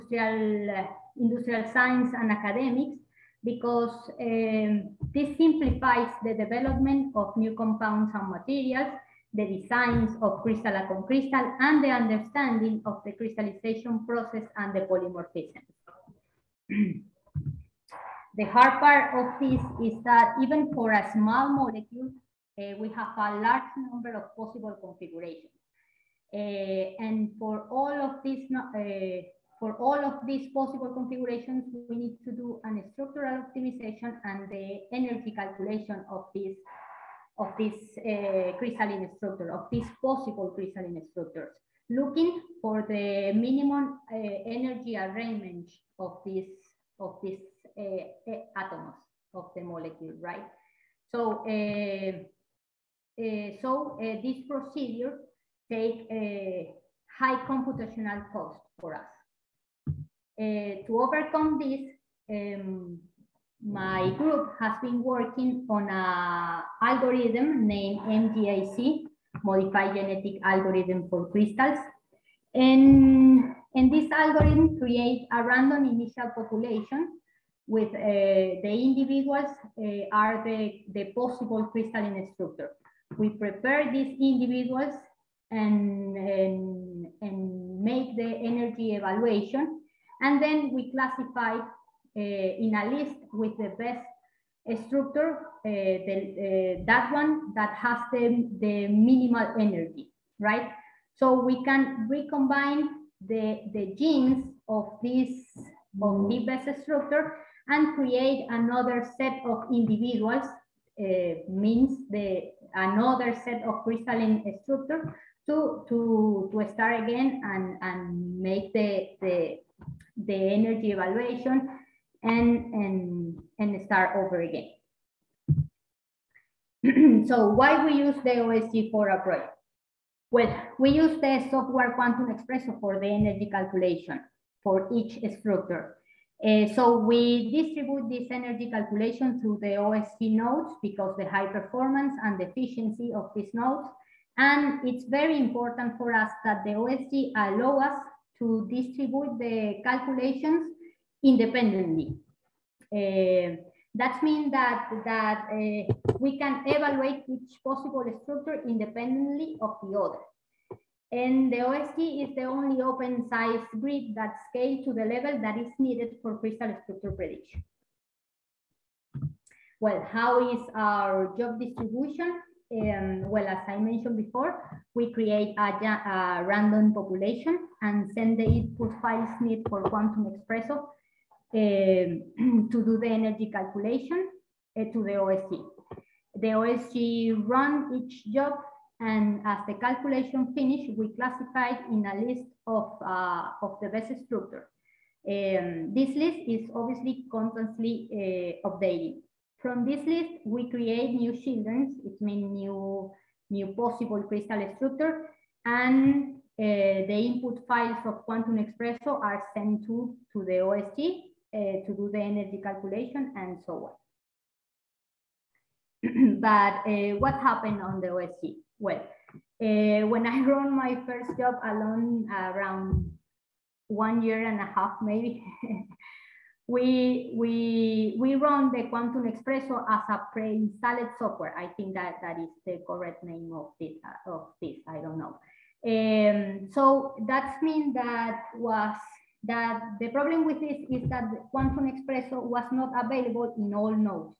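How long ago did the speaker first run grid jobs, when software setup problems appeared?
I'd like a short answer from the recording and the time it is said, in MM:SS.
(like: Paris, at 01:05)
1.5 years, at 03:43.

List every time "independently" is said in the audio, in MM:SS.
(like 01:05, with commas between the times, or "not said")
02:31, 02:38.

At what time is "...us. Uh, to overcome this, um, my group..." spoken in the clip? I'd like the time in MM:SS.
00:58.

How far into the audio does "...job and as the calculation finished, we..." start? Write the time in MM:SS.
03:08.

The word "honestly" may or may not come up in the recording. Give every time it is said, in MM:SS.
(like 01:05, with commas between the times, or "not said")
not said.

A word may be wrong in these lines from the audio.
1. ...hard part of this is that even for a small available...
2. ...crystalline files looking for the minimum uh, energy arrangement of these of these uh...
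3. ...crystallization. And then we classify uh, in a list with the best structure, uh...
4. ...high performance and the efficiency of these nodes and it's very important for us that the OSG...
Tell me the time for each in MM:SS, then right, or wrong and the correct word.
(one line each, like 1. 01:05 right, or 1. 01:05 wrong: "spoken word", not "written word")
1. 00:18 wrong: "molecule", not "available"
2. 00:40 wrong: "structures", not "files"
3. 01:28 wrong: "evaluation", not "crystallization"
4. 02:21 right.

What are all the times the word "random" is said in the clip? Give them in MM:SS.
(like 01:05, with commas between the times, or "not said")
01:15, 02:56.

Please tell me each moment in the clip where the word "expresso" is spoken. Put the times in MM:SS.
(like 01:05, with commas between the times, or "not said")
02:12, 03:00, 03:28.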